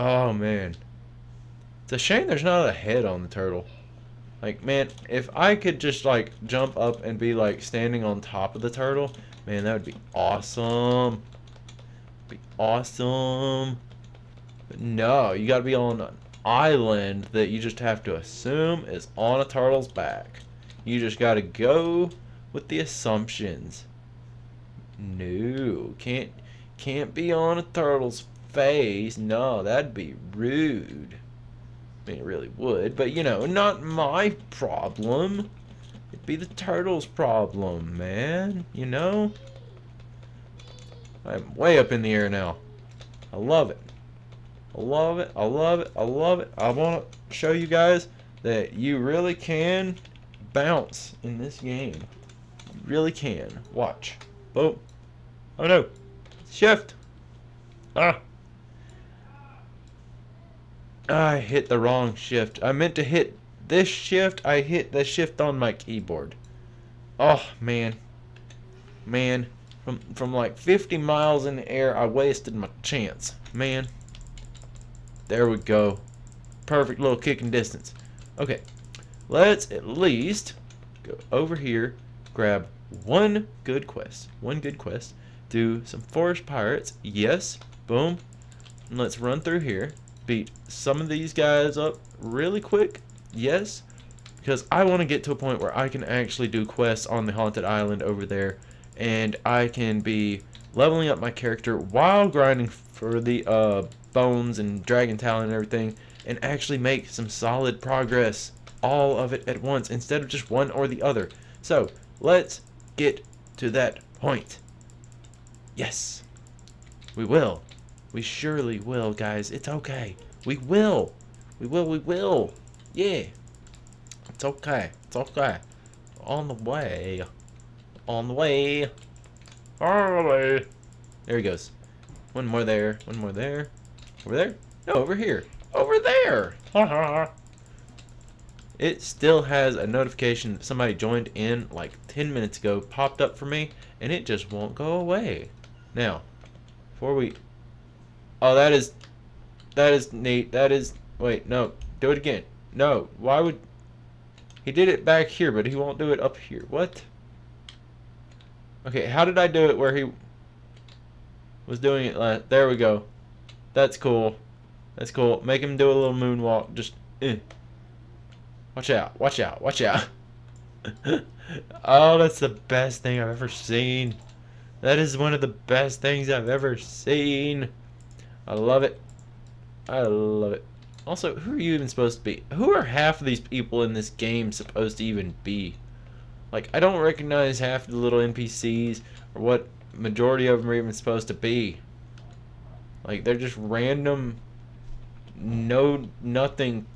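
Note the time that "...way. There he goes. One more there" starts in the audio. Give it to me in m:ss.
2:10.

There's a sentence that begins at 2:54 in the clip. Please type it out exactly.
That is one of the best things I've ever seen.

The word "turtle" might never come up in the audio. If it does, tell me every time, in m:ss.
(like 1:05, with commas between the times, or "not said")
0:03, 0:08, 0:19, 0:27, 0:36.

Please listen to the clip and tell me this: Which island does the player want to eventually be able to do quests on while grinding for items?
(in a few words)
Haunted Island.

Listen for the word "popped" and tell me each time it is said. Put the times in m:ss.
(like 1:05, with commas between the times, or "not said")
2:22.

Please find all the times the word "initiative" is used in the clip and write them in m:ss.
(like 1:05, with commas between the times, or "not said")
not said.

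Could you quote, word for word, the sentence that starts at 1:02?
I meant to hit this shift.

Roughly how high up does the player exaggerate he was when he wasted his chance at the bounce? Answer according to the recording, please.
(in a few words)
50 miles.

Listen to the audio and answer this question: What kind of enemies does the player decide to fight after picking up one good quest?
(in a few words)
forest pirates.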